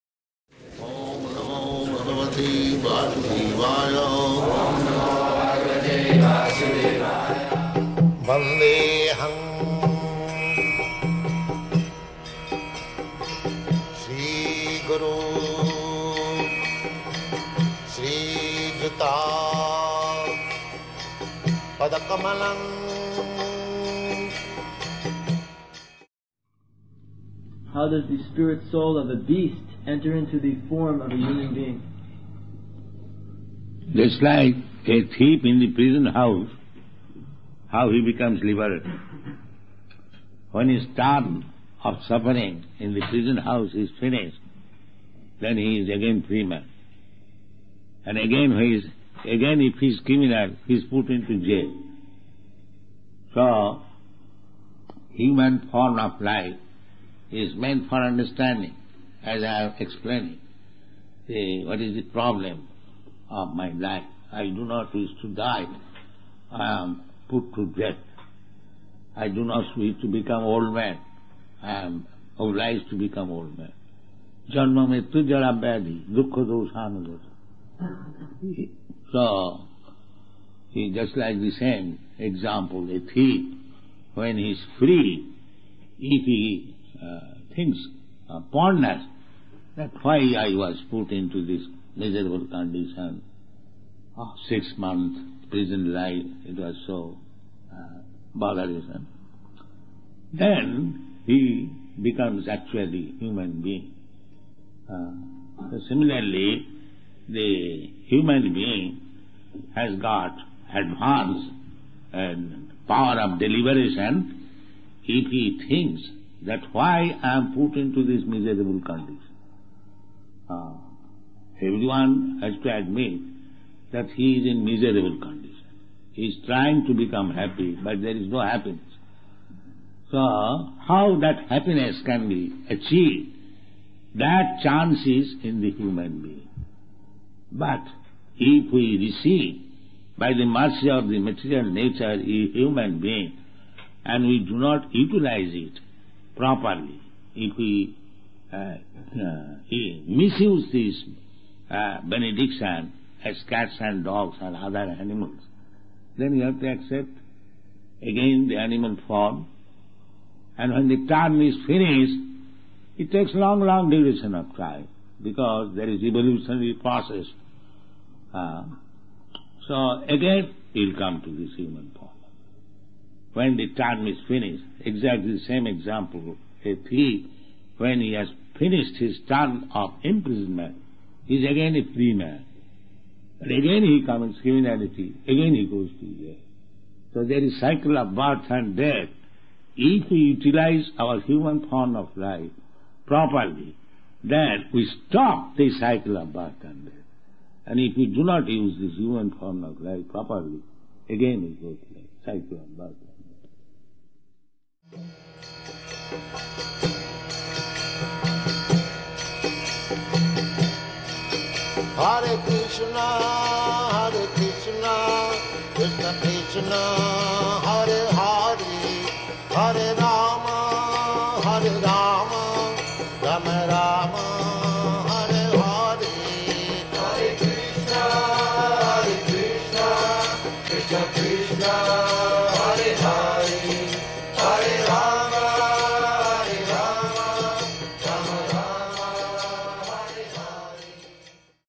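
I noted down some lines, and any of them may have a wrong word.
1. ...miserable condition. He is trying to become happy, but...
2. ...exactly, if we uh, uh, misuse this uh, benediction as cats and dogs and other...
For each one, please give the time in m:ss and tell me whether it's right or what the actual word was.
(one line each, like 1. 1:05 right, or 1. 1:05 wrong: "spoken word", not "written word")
1. 2:04 right
2. 2:26 wrong: "properly", not "exactly".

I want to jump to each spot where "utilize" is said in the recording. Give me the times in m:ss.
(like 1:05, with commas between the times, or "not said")
2:24, 3:10.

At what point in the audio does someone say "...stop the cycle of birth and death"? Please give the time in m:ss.
3:15.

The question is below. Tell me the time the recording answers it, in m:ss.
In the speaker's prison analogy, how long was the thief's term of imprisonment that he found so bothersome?
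1:34.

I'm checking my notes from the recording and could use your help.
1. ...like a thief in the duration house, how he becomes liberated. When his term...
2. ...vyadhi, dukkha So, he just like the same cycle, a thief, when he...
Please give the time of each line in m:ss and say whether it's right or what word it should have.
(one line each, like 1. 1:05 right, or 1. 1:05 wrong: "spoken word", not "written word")
1. 0:34 wrong: "prison", not "duration"
2. 1:15 wrong: "example", not "cycle".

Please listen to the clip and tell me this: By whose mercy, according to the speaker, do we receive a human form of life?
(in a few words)
Material nature.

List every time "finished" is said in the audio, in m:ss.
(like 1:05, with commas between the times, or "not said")
0:43, 2:41, 2:54, 2:58.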